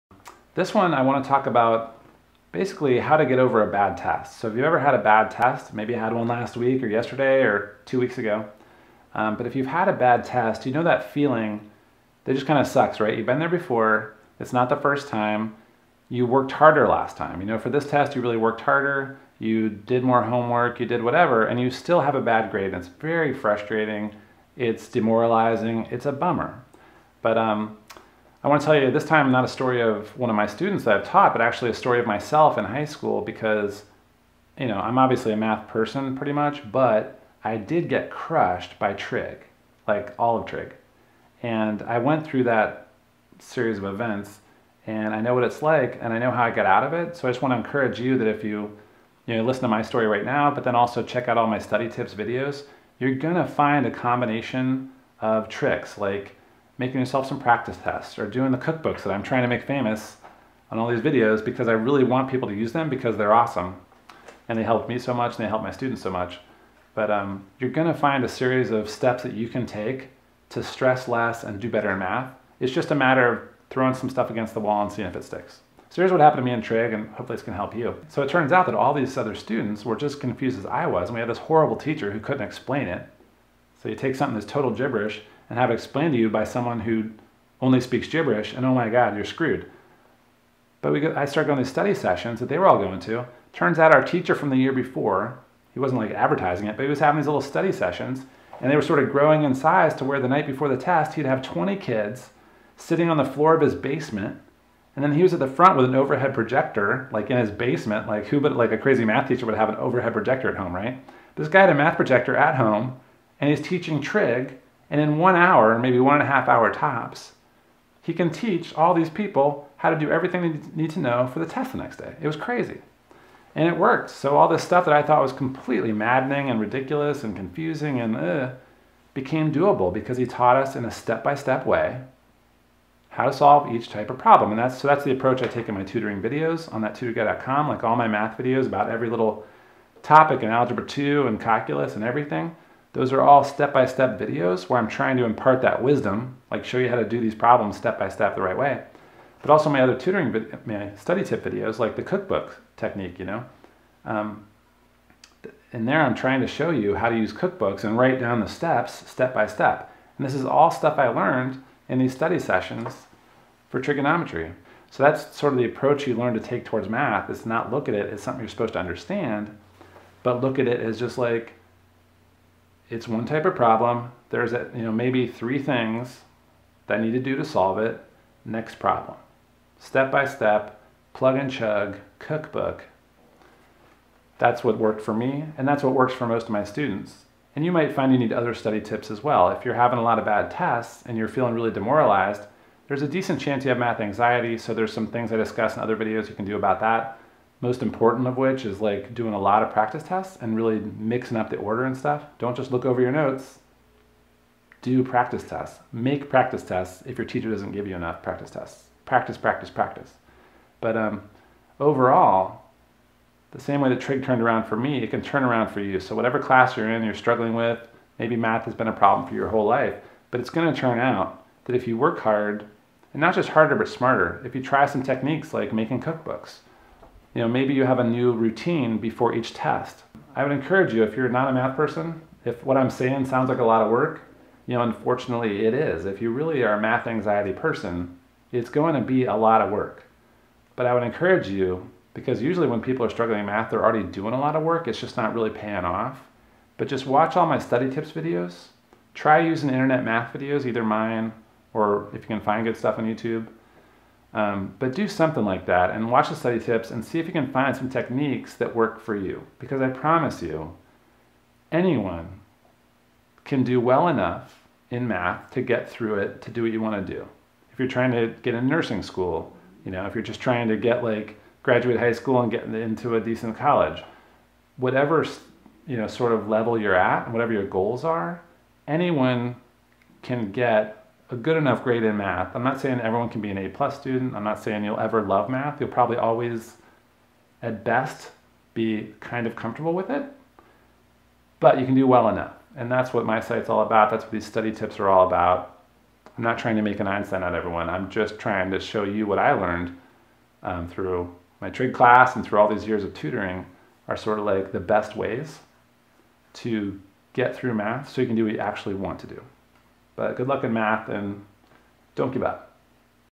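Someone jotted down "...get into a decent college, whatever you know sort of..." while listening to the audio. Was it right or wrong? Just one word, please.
right.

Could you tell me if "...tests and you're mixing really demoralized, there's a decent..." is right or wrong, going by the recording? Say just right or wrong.
wrong.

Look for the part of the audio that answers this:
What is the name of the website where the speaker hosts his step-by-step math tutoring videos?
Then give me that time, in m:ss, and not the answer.
2:16.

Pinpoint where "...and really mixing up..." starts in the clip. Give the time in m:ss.
3:20.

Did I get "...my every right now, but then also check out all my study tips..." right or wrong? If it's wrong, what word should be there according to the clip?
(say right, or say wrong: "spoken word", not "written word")
wrong: "story", not "every".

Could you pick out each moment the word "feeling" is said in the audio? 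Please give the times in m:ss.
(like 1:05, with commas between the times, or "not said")
0:11, 3:11.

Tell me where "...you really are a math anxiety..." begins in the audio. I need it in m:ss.
3:56.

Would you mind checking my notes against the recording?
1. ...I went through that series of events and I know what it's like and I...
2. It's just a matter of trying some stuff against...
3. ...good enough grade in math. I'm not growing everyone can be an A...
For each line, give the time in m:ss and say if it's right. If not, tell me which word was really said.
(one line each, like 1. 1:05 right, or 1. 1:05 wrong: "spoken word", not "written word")
1. 0:41 right
2. 1:12 wrong: "throwing", not "trying"
3. 4:41 wrong: "saying", not "growing".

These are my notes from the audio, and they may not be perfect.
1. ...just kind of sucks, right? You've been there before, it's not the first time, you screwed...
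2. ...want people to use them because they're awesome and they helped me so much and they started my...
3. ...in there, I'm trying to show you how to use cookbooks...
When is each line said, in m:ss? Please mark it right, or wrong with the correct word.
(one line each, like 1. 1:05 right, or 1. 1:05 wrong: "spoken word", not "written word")
1. 0:12 wrong: "worked", not "screwed"
2. 1:02 wrong: "helped", not "started"
3. 2:35 right.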